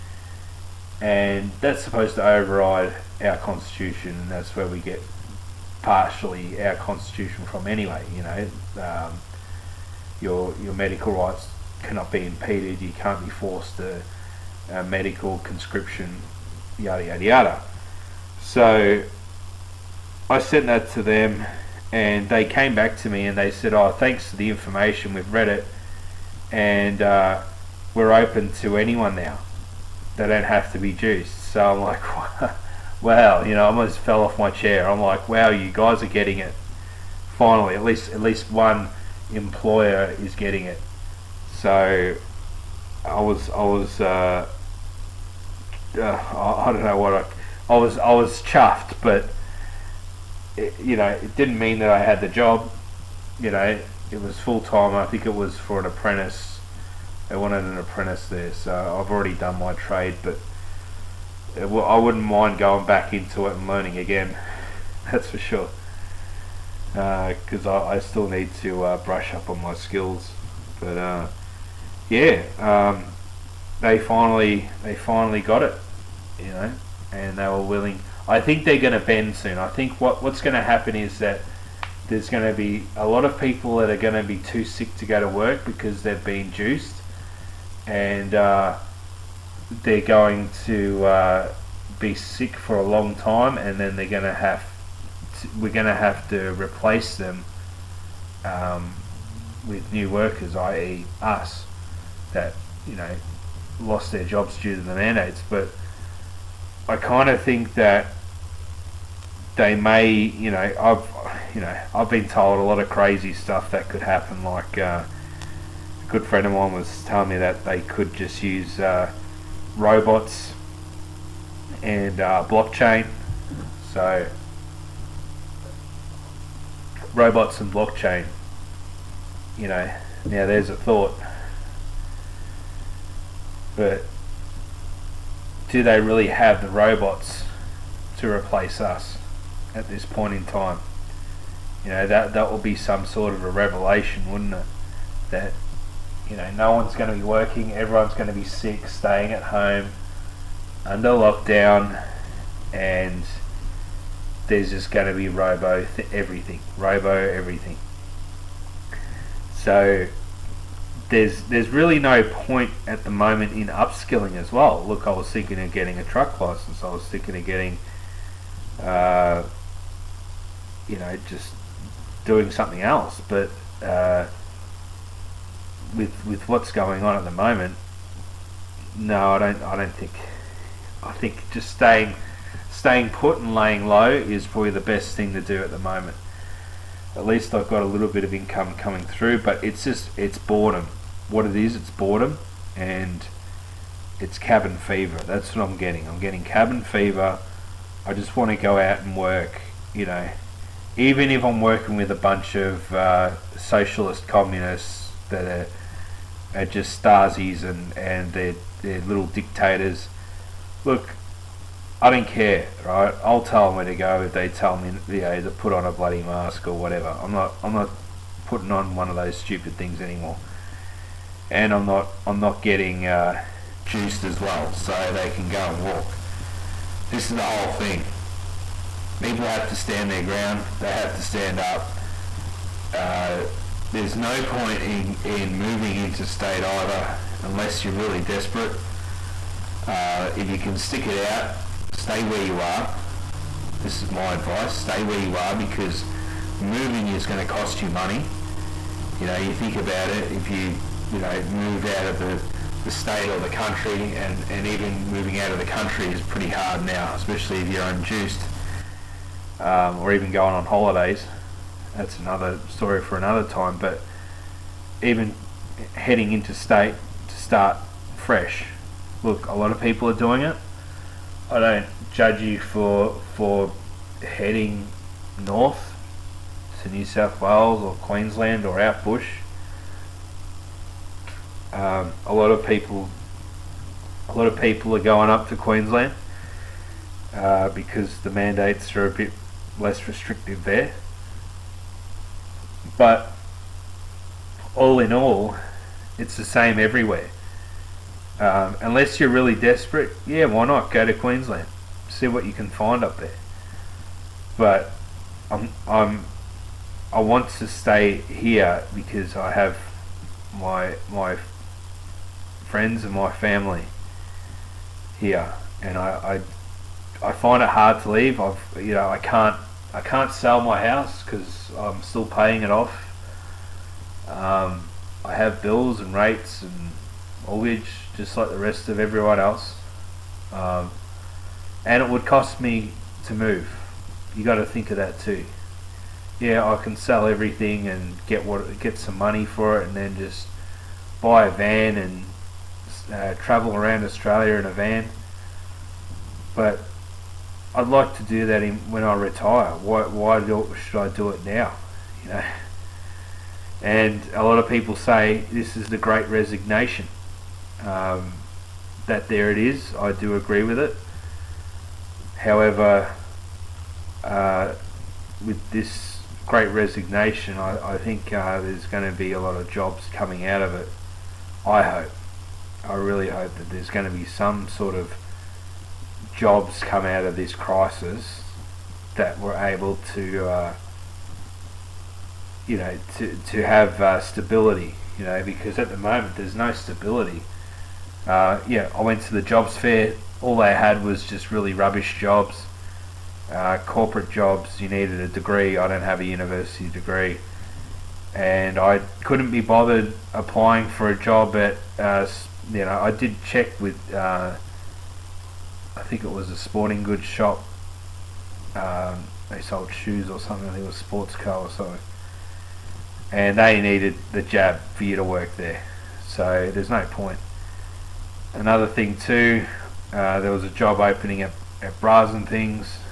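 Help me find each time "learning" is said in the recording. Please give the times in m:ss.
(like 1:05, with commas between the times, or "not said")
1:03.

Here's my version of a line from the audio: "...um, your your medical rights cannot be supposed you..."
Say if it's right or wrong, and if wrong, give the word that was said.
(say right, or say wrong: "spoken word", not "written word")
wrong: "impeded", not "supposed".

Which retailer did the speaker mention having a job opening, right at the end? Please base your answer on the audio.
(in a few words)
Bras and Things.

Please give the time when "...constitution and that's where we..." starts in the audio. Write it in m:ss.
0:03.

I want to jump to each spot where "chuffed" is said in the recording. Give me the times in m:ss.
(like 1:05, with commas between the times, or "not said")
0:48.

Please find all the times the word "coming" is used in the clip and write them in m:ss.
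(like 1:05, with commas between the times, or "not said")
3:08, 6:10.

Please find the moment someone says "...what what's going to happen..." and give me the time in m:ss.
1:20.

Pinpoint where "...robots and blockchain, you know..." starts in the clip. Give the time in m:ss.
2:07.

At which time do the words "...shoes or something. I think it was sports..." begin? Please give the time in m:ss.
6:49.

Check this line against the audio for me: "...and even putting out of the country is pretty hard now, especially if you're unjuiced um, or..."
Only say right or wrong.
wrong.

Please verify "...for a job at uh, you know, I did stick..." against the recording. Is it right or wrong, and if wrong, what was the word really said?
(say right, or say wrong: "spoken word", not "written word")
wrong: "check", not "stick".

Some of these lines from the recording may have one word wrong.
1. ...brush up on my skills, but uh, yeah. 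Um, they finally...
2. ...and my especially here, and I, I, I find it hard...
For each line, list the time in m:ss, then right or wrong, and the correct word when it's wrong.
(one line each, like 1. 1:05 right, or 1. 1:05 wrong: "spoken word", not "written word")
1. 1:09 right
2. 5:13 wrong: "family", not "especially".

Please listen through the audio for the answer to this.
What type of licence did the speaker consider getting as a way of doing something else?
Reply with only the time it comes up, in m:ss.
2:46.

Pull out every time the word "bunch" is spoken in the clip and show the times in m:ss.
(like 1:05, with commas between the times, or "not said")
3:22.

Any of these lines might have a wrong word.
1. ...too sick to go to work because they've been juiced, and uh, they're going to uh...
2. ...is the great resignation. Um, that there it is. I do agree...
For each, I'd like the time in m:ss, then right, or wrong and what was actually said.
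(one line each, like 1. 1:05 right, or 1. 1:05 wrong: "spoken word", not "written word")
1. 1:24 right
2. 5:55 right.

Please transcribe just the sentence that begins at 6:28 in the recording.
Uh, yeah, I went to the jobs fair, all they had was just really rubbish jobs.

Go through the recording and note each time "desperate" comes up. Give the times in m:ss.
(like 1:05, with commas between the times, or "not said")
3:58, 4:59.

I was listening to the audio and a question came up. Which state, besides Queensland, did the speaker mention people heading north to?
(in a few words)
New South Wales.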